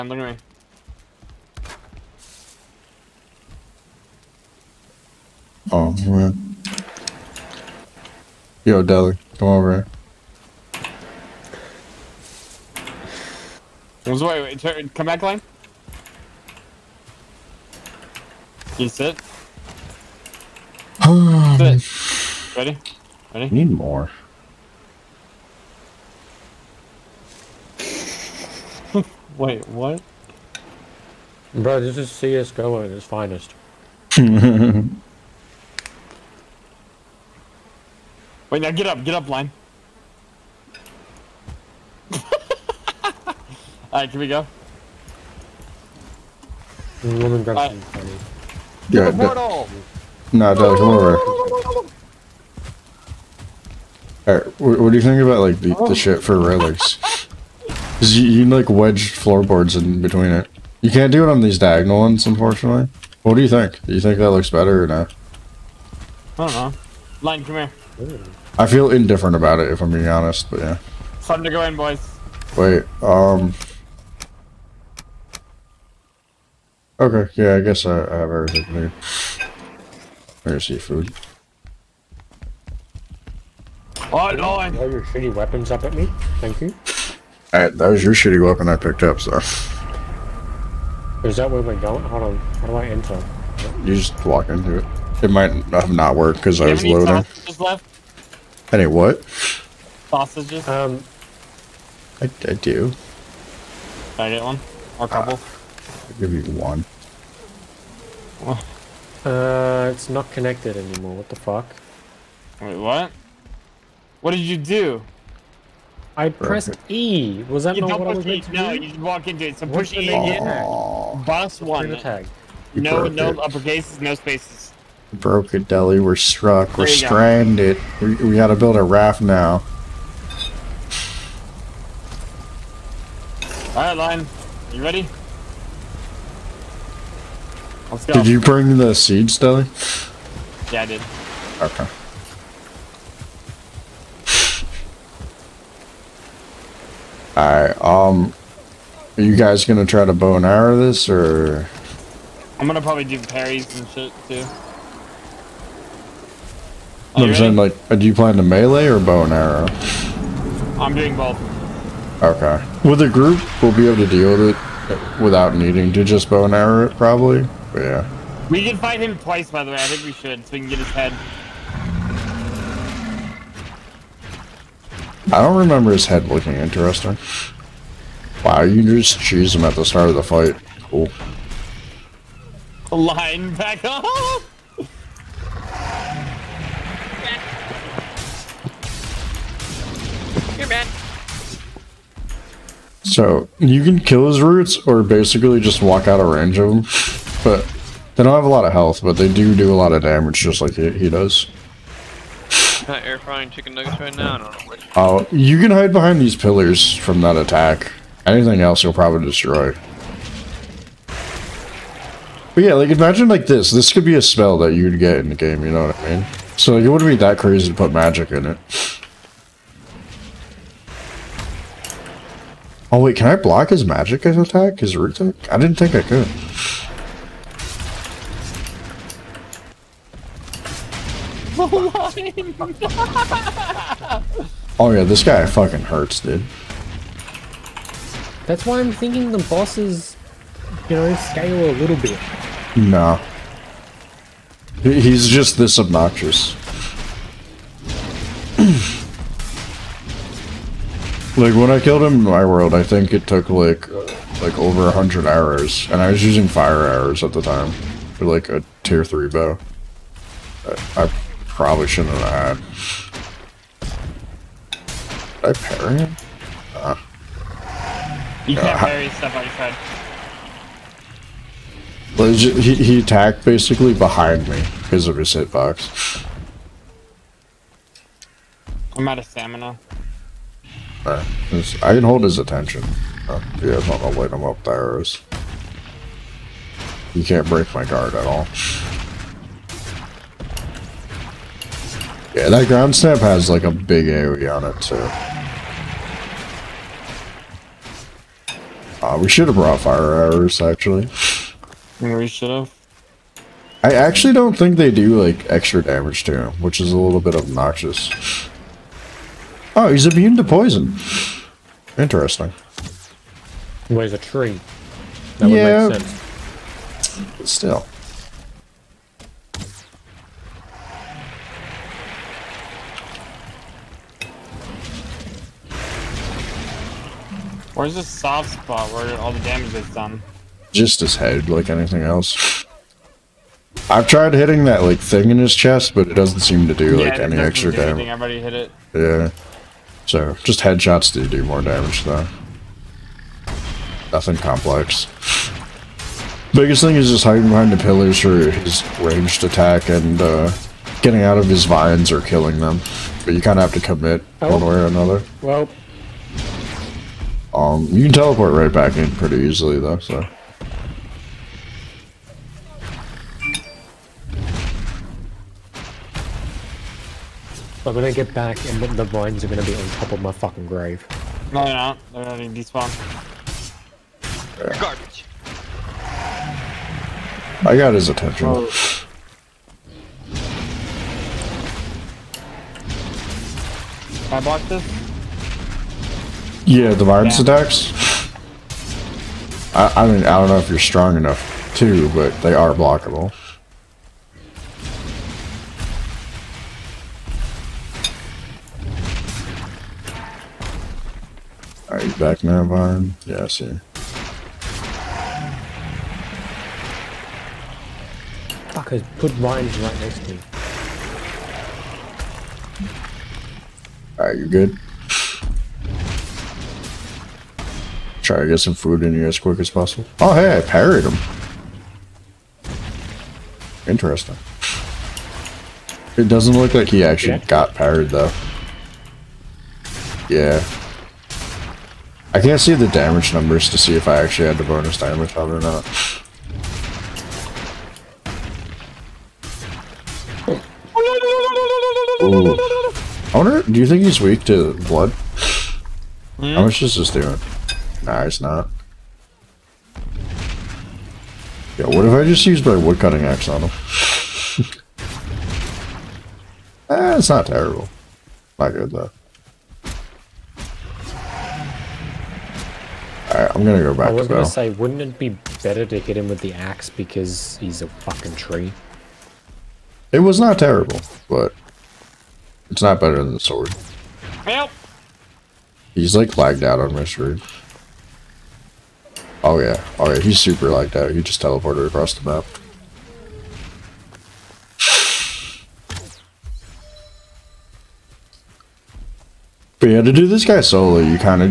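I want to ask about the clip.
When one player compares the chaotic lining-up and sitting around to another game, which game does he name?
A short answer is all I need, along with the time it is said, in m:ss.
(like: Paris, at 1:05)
CSGO, at 0:32.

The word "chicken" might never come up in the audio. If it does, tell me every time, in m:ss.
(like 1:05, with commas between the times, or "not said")
3:23.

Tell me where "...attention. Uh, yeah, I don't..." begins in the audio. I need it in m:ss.
4:42.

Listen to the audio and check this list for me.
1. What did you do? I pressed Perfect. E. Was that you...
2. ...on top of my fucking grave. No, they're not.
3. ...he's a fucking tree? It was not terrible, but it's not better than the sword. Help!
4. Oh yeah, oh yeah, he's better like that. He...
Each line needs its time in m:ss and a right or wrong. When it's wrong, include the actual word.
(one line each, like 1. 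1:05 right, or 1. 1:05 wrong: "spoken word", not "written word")
1. 1:54 right
2. 6:09 right
3. 7:47 right
4. 7:59 wrong: "super", not "better".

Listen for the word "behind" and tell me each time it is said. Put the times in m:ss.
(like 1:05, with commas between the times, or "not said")
3:25, 4:33, 5:47.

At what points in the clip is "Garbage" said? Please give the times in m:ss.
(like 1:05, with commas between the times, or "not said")
6:14.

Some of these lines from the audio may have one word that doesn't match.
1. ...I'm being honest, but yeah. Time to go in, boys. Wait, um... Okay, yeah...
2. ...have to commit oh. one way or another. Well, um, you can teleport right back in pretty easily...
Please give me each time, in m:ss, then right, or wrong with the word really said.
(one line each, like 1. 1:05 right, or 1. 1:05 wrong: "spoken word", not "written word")
1. 1:09 right
2. 5:53 right.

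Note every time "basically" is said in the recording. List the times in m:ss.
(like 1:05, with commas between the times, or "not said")
3:15, 4:33.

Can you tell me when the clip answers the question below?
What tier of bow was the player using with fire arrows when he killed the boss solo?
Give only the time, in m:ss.
4:18.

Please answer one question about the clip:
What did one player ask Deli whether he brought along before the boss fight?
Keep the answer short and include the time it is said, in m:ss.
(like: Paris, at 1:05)
Seeds, at 2:18.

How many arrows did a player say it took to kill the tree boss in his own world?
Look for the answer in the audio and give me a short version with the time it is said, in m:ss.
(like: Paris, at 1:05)
Over 100, at 4:14.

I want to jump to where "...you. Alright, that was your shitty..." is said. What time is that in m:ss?
1:26.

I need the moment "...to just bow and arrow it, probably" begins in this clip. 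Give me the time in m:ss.
2:45.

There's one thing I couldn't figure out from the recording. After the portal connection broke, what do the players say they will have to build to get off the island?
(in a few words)
A raft.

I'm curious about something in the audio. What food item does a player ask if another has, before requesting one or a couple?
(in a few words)
Sausages.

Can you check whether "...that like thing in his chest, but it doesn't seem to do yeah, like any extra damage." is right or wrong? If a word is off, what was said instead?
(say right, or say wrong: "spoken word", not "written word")
right.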